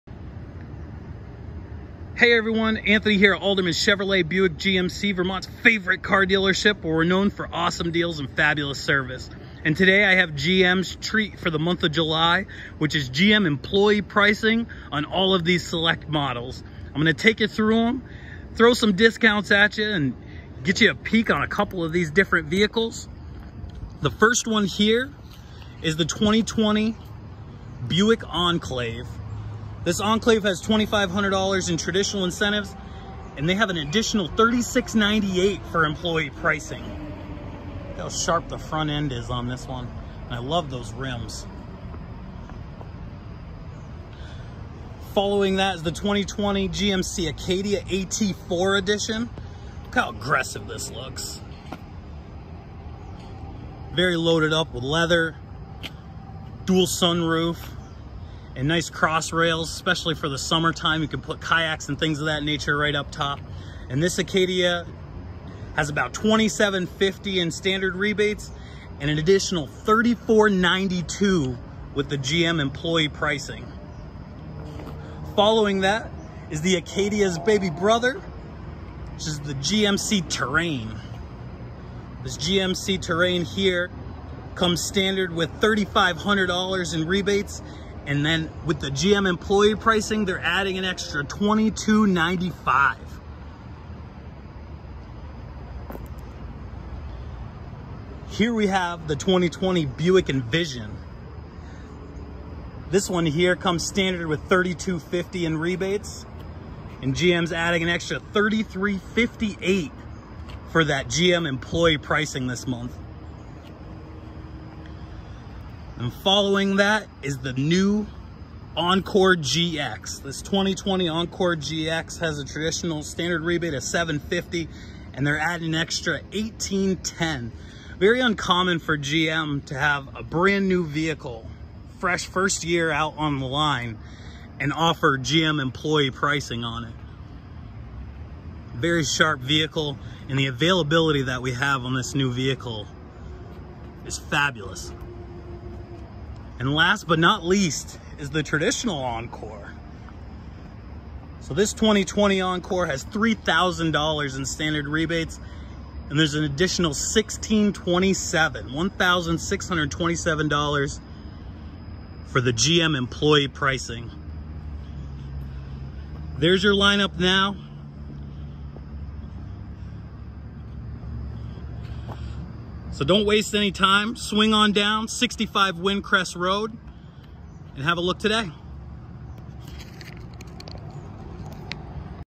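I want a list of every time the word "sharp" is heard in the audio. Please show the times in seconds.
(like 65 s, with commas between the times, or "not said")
38 s, 139 s.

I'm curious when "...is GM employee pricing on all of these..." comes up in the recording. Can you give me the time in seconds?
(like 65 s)
12 s.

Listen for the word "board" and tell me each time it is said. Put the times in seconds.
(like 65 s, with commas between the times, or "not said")
not said.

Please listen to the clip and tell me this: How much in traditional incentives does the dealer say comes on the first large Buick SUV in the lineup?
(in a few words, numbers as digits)
$2,500.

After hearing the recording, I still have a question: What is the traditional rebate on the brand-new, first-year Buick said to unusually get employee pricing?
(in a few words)
$750.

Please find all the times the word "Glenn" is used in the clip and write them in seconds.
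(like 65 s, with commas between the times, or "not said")
not said.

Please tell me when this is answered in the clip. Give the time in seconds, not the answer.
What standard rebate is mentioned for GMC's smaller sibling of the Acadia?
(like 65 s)
85 s.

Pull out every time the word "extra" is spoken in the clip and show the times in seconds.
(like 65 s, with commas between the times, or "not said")
90 s, 107 s, 125 s.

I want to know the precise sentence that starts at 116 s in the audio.
And following that is the new Encore GX.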